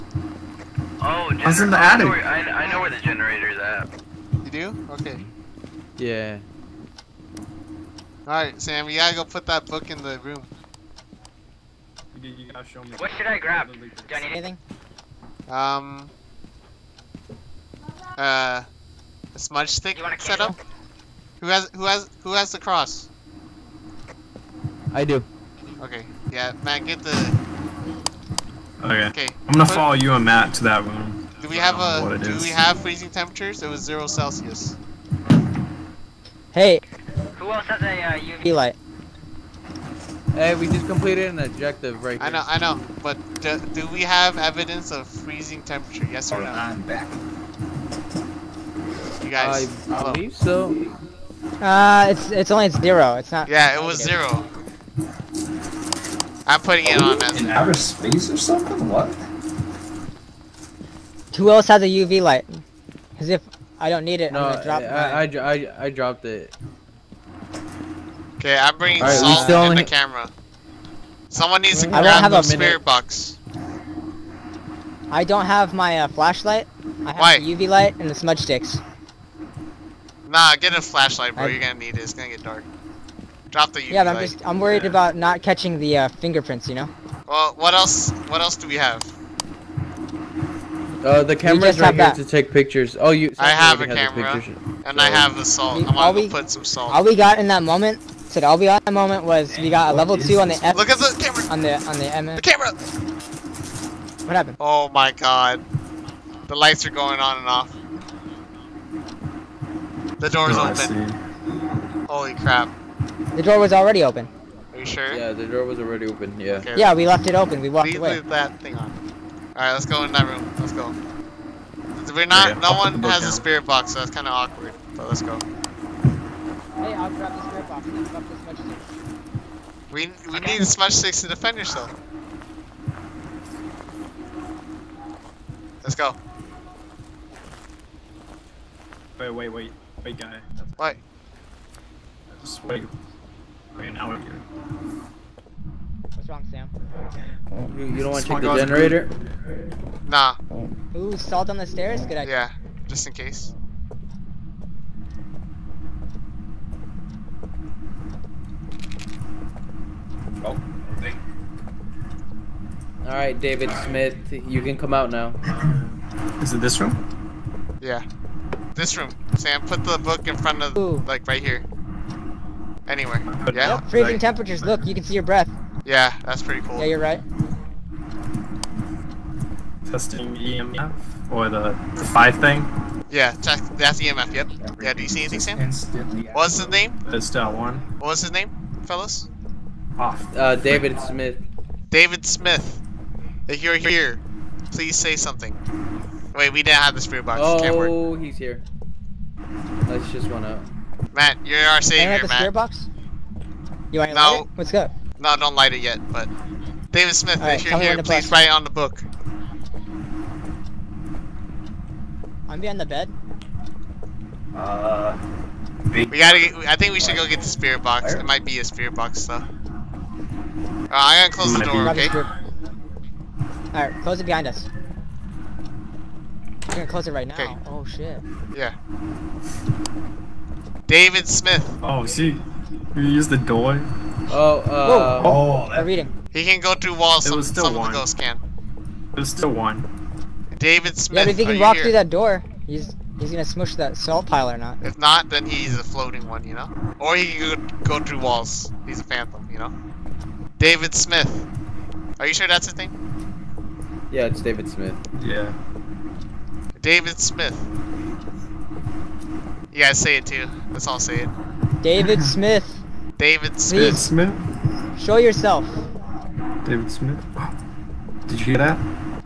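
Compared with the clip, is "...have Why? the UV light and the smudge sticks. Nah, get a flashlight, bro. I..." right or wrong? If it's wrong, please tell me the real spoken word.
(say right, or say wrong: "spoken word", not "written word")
right.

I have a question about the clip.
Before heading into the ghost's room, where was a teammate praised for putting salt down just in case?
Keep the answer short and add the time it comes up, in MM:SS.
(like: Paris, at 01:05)
the stairs, at 02:31.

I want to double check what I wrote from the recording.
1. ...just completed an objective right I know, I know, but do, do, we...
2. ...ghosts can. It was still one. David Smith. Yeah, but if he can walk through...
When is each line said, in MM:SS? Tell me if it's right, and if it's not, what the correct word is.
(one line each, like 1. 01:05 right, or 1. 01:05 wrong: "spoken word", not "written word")
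1. 00:40 right
2. 03:58 right.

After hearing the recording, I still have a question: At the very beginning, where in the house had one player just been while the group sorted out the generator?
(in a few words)
attic.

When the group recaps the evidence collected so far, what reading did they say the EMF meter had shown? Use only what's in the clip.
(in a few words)
level 2.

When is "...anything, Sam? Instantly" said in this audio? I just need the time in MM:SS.
03:05.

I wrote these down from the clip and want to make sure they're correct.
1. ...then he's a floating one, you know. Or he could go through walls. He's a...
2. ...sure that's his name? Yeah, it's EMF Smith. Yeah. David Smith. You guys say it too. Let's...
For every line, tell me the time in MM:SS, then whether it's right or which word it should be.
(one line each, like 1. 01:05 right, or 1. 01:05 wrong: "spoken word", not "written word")
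1. 04:05 right
2. 04:12 wrong: "David", not "EMF".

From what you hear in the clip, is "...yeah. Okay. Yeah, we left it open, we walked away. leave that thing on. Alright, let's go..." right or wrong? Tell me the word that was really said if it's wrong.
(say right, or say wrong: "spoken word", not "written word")
right.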